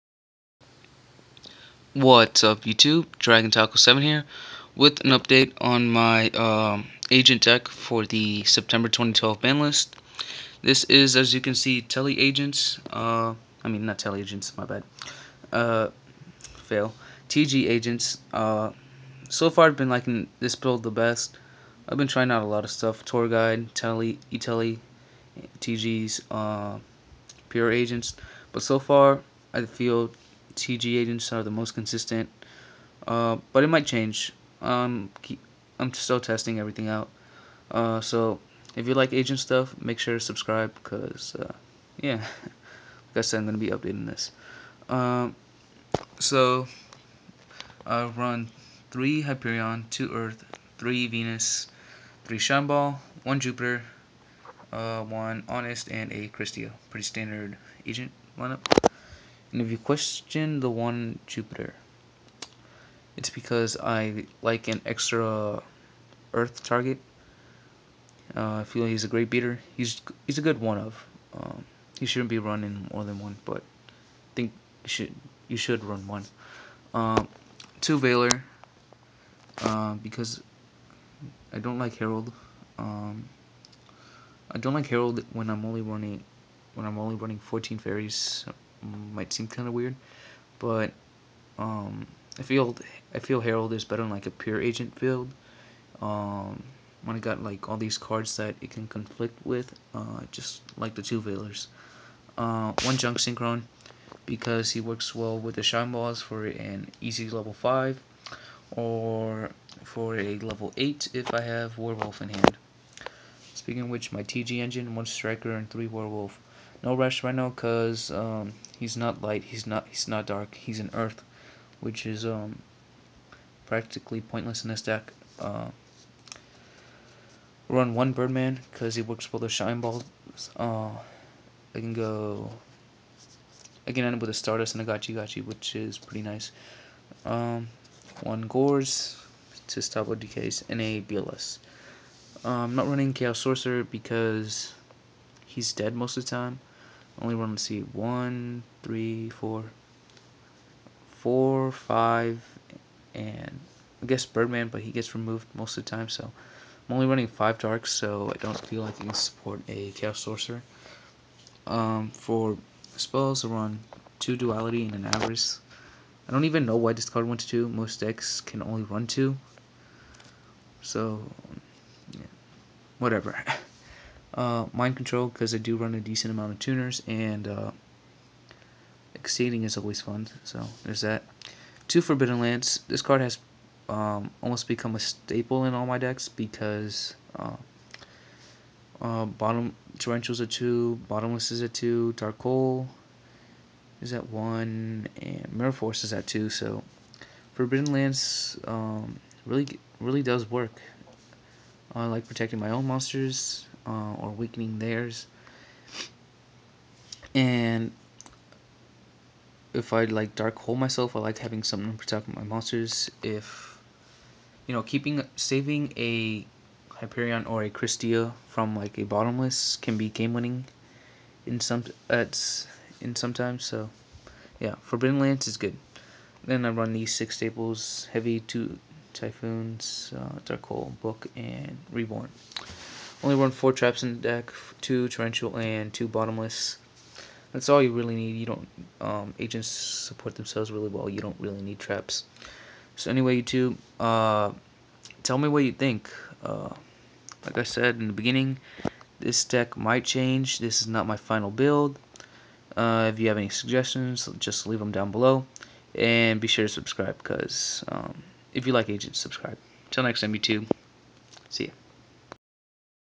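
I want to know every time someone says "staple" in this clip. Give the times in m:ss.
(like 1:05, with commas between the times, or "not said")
3:04, 3:47.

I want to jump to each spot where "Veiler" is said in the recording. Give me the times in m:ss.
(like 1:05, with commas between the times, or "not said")
1:17, 1:41.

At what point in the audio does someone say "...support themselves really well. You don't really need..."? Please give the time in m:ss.
3:59.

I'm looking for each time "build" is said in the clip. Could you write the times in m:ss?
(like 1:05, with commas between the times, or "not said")
0:20, 1:34, 4:11.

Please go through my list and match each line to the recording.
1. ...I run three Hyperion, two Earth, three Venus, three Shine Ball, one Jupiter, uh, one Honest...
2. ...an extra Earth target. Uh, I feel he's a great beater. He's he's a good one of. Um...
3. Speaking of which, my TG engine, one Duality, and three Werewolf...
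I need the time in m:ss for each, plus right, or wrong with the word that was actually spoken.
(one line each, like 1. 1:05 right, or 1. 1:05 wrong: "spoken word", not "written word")
1. 0:47 right
2. 1:04 right
3. 1:53 wrong: "Striker", not "Duality".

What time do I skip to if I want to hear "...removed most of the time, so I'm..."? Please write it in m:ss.
2:35.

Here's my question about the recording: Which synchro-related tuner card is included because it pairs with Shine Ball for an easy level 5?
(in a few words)
Junk Synchron.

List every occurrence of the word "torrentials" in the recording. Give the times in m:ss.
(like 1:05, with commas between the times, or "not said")
3:09, 3:55.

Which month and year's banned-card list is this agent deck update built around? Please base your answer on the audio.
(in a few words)
September 2012.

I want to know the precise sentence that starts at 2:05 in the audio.
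Uh, run one Birdman because he works with the Shine Balls.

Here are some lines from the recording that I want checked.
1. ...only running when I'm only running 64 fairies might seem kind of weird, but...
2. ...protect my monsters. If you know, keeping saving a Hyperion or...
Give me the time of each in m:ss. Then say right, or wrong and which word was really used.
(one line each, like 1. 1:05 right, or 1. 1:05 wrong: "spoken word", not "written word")
1. 1:25 wrong: "14", not "64"
2. 3:31 right.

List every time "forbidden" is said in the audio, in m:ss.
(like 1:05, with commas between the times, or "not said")
3:02, 3:17, 3:44.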